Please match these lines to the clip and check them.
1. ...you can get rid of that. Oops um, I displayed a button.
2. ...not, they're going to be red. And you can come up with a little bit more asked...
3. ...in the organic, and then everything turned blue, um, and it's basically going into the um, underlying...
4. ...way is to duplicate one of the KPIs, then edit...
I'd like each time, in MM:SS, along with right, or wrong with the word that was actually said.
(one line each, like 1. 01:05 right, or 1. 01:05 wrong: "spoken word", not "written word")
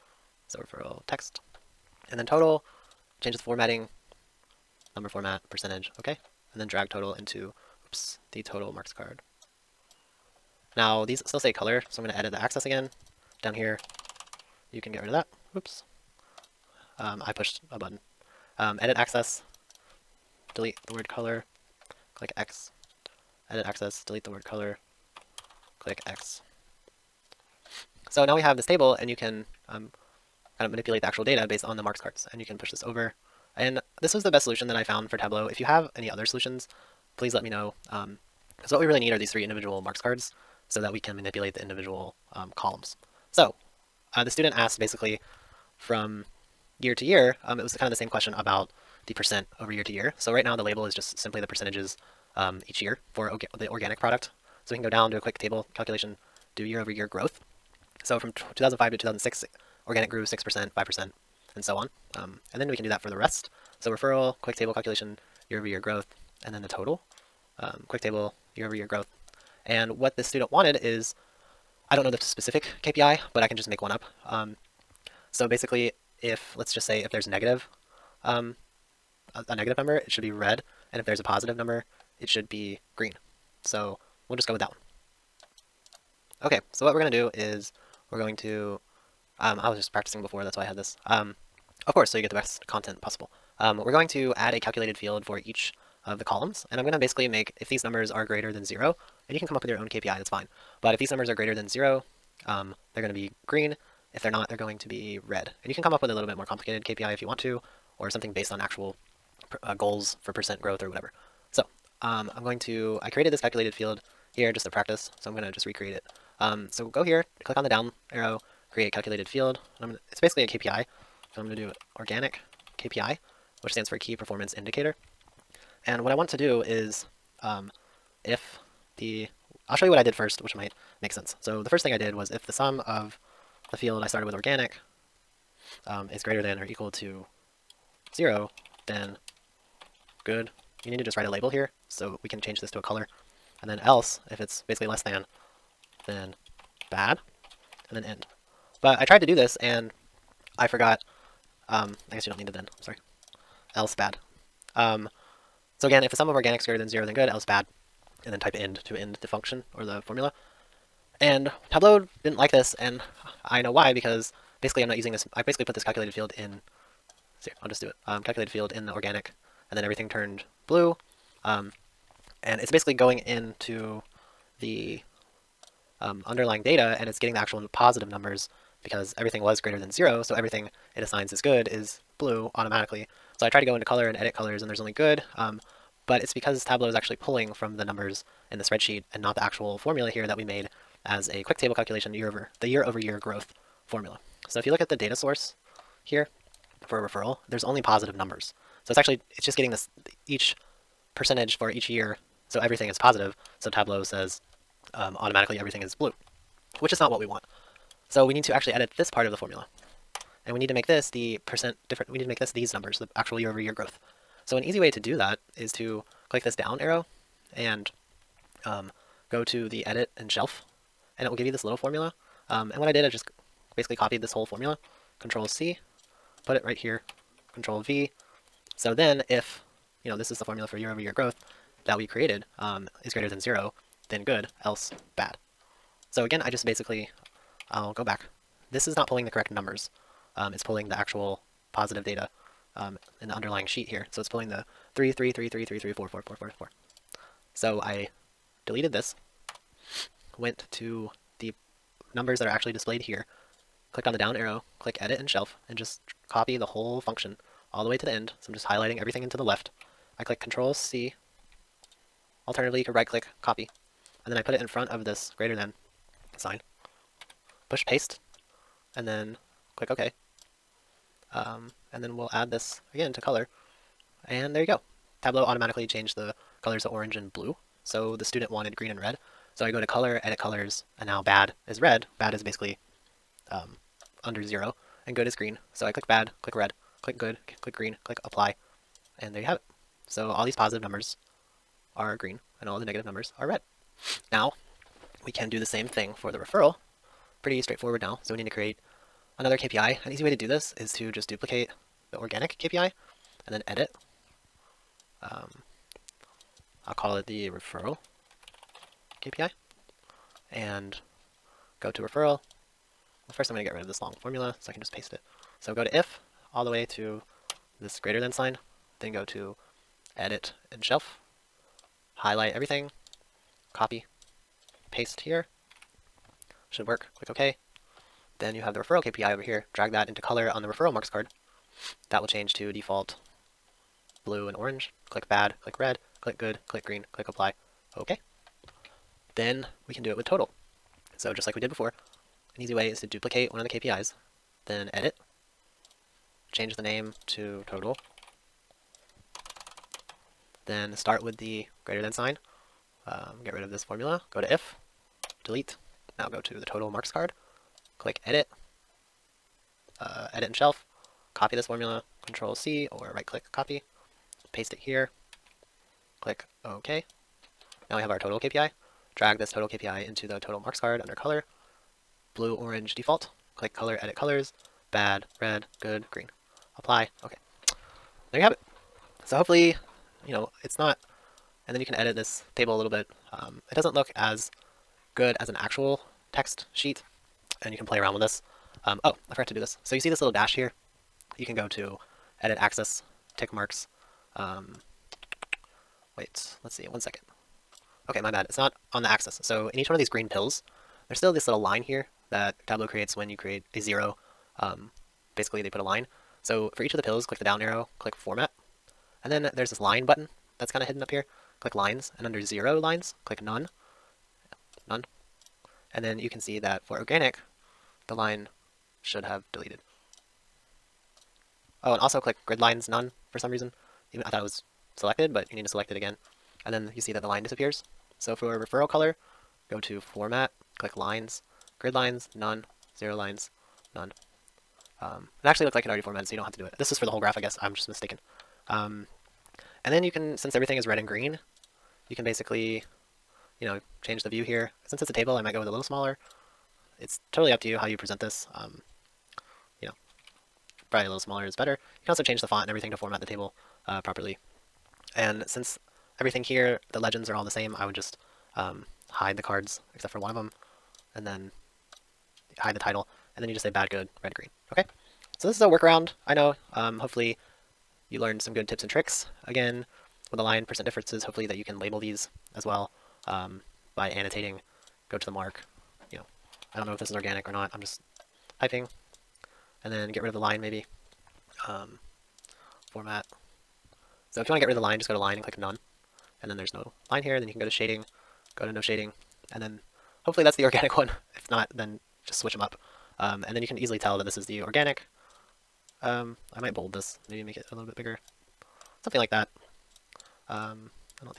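1. 00:14 wrong: "pushed", not "displayed"
2. 01:44 wrong: "complicated", not "asked"
3. 02:48 right
4. 05:42 right.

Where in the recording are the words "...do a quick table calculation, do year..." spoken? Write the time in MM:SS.
00:55.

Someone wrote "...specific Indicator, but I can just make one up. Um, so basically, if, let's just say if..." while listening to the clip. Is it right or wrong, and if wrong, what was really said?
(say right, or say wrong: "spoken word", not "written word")
wrong: "KPI", not "Indicator".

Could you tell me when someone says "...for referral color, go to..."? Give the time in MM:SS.
07:08.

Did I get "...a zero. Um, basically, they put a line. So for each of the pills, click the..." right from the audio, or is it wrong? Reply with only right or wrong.
right.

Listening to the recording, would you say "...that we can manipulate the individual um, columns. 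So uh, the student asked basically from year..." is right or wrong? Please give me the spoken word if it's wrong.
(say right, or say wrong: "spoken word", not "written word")
right.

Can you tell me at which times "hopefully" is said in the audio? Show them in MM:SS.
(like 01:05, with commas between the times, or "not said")
06:19, 07:46, 07:51, 08:10.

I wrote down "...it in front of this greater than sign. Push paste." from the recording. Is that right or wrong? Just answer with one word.
right.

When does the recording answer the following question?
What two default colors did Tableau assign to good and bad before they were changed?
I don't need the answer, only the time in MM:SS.
04:36.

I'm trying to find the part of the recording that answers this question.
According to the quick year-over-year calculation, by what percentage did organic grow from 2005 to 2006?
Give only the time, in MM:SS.
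01:00.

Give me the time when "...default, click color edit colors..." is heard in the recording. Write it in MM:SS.
06:12.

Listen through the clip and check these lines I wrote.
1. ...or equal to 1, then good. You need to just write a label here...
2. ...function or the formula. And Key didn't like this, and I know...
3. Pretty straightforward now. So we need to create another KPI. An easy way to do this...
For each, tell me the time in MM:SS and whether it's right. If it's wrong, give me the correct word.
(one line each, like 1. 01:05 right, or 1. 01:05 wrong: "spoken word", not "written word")
1. 02:16 wrong: "0", not "1"
2. 02:39 wrong: "Tableau", not "Key"
3. 04:57 right.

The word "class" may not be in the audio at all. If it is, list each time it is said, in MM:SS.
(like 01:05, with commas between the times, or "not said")
not said.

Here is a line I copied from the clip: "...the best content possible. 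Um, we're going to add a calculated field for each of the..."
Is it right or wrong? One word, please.
right.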